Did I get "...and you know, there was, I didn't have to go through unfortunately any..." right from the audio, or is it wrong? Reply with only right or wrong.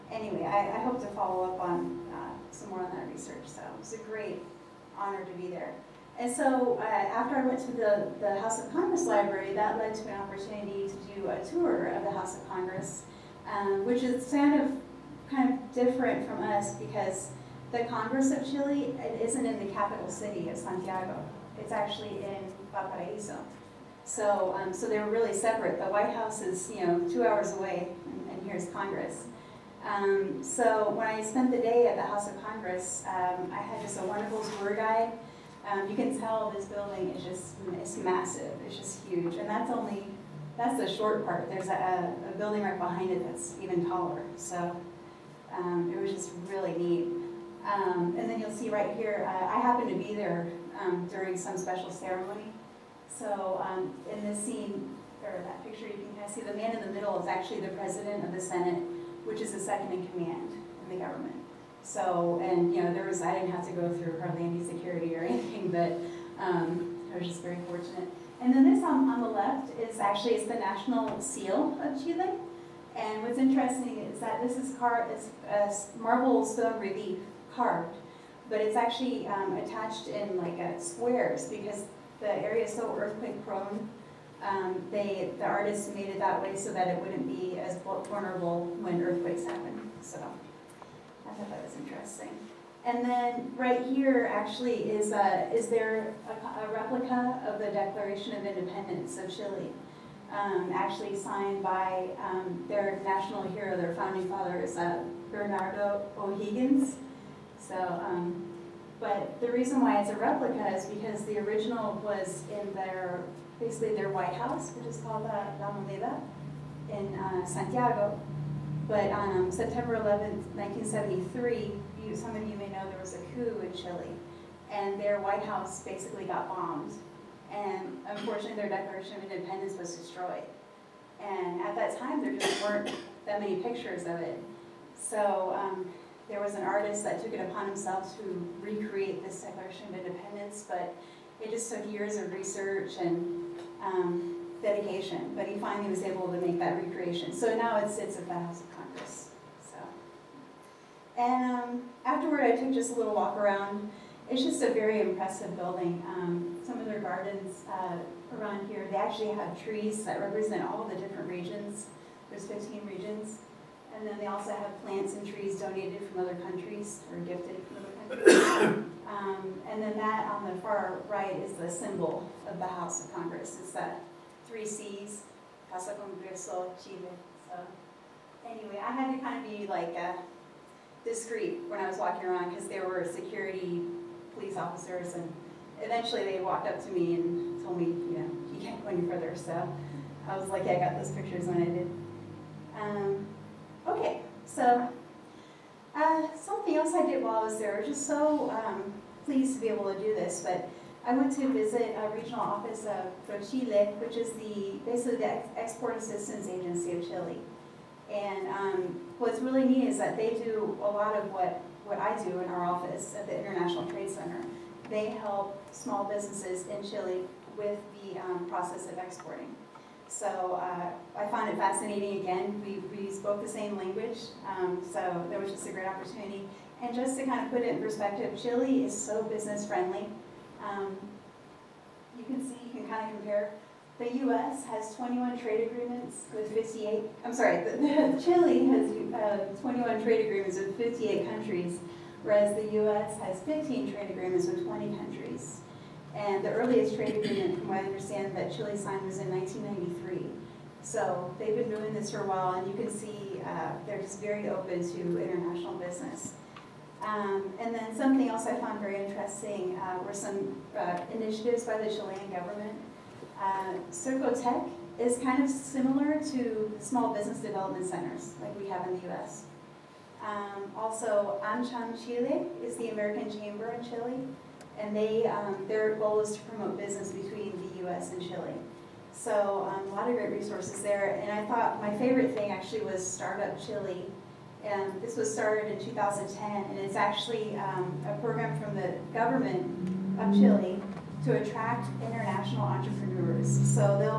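wrong.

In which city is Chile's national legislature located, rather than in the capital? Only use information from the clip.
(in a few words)
Valparaiso.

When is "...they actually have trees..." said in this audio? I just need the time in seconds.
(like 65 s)
158 s.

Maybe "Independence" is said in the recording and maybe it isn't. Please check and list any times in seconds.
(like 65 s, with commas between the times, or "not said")
98 s, 129 s, 140 s.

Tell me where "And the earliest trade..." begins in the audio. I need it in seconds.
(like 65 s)
246 s.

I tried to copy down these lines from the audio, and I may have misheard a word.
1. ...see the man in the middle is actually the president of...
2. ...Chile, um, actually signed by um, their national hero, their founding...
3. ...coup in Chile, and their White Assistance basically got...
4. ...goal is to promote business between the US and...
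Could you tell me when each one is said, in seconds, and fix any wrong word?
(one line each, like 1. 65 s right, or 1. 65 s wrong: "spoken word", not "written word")
1. 56 s right
2. 99 s right
3. 123 s wrong: "House", not "Assistance"
4. 275 s right.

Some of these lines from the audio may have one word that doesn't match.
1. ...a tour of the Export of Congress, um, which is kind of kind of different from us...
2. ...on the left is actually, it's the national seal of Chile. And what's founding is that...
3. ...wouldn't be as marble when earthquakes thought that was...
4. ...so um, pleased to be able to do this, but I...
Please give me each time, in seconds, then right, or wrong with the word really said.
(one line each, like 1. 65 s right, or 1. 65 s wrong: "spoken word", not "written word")
1. 11 s wrong: "House", not "Export"
2. 69 s wrong: "interesting", not "founding"
3. 86 s wrong: "vulnerable", not "marble"
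4. 198 s right.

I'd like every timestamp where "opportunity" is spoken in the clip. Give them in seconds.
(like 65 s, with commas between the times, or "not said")
10 s, 225 s.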